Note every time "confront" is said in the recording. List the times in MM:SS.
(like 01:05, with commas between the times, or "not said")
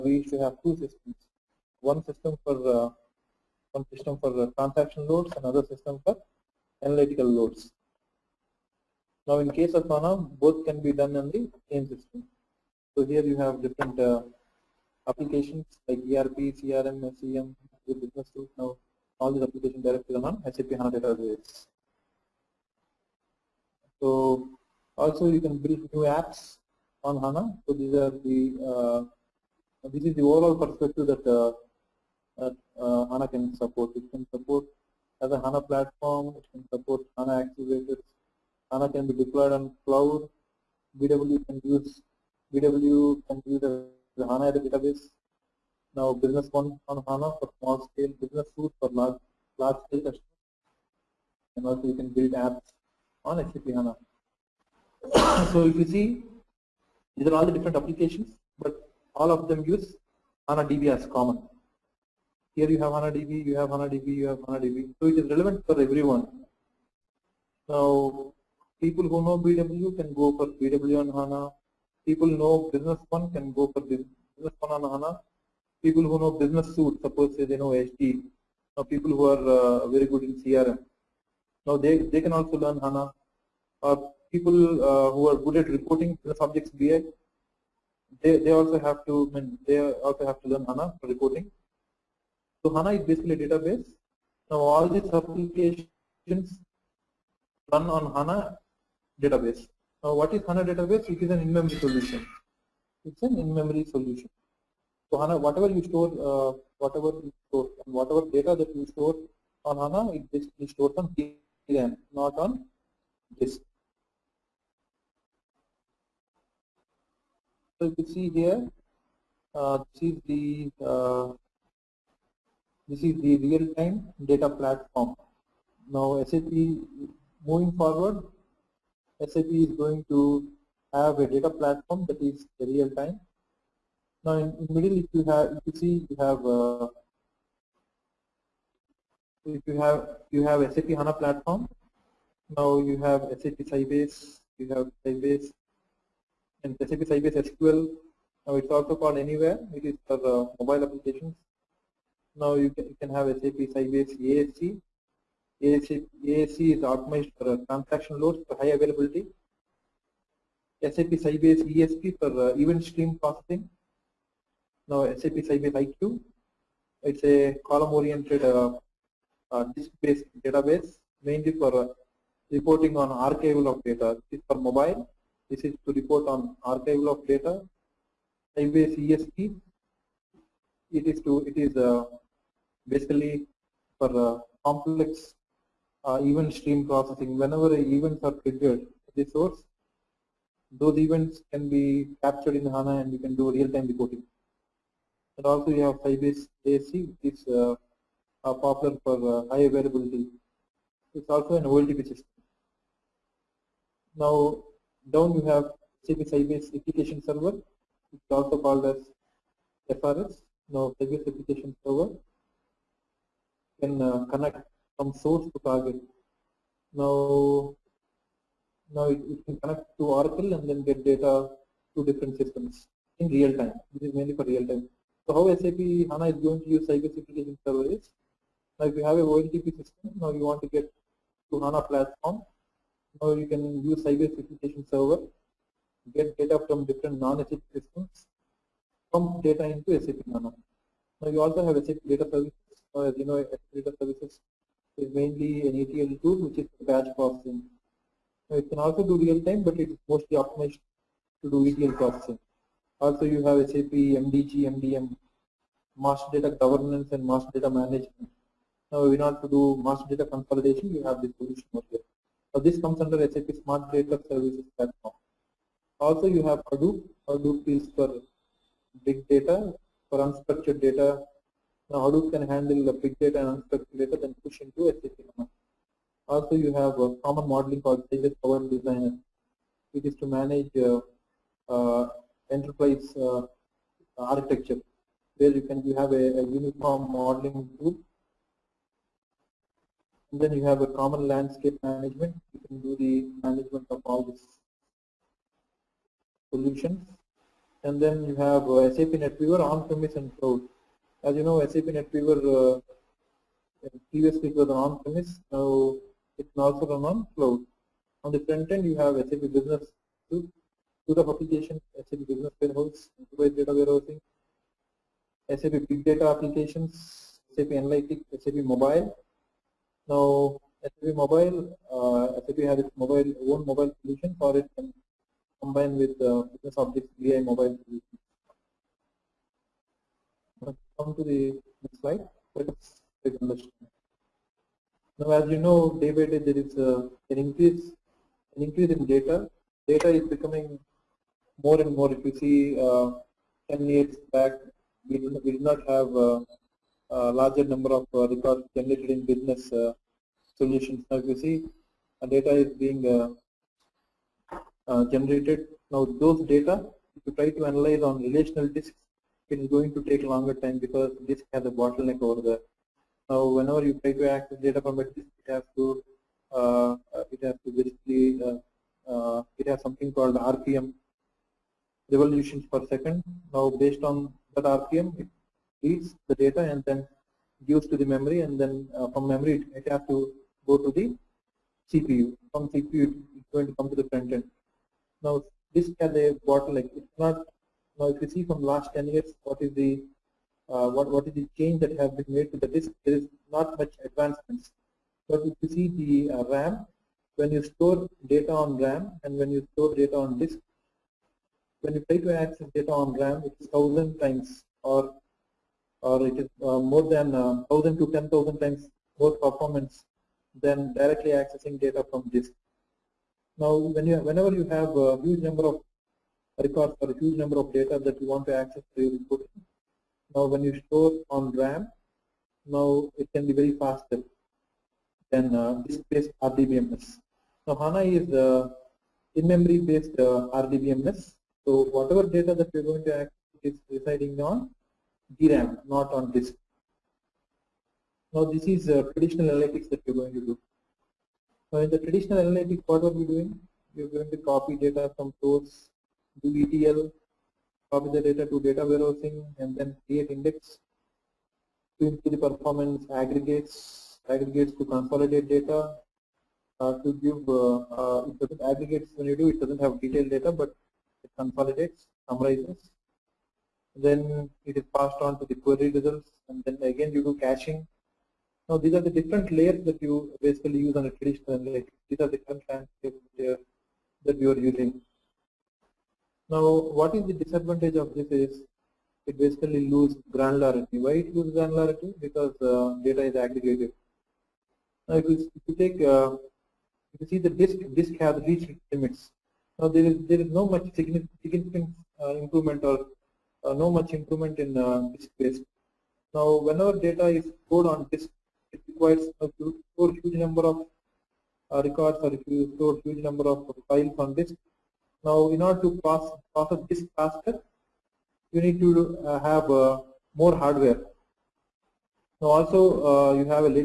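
not said.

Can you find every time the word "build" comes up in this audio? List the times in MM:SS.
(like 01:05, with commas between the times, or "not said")
00:25, 00:52.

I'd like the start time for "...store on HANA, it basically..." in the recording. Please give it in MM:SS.
01:48.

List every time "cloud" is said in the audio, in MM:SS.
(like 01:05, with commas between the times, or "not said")
00:39, 05:00, 05:07.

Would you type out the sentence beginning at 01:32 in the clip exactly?
So HANA is basically a database.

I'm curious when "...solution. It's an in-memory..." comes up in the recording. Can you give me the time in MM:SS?
01:41.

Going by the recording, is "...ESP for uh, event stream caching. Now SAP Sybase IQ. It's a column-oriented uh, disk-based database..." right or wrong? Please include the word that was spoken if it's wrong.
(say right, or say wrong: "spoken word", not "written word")
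wrong: "processing", not "caching".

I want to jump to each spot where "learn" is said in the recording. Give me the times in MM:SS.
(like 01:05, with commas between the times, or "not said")
01:22, 01:30.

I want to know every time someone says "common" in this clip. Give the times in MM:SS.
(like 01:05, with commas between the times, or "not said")
01:01, 04:37, 04:50.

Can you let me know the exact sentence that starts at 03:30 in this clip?
Now Sybase application server can uh, connect from source to target.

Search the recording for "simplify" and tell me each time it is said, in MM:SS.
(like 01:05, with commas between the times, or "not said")
not said.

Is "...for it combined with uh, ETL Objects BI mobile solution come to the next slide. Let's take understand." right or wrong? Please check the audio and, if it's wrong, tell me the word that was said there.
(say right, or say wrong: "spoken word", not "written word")
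wrong: "Business", not "ETL".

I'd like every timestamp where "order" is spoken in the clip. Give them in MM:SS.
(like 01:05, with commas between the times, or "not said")
04:19, 08:25.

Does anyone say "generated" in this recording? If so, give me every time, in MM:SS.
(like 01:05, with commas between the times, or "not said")
05:48, 05:55.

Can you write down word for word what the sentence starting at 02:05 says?
Now SAP moving forward, SAP is going to have a data platform that is real time.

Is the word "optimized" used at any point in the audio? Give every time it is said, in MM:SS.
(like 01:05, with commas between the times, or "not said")
02:36, 04:10.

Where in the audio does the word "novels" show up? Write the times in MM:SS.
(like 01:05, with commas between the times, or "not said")
not said.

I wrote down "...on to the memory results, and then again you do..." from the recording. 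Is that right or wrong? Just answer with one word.
wrong.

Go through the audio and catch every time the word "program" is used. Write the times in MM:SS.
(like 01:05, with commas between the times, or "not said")
not said.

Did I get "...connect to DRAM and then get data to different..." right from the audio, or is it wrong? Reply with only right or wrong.
wrong.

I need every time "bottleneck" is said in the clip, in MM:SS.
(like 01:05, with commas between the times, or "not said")
06:01, 06:26.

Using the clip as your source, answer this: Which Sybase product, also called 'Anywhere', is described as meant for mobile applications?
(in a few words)
SAP Sybase SQL.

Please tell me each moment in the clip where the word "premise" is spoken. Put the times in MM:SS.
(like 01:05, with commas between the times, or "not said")
04:59, 05:04.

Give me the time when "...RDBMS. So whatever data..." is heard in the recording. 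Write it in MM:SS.
07:10.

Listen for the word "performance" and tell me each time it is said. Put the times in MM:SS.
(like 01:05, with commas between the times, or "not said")
06:49, 07:32.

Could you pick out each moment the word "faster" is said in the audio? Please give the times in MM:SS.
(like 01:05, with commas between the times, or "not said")
07:03, 08:27.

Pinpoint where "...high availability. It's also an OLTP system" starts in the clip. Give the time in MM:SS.
03:19.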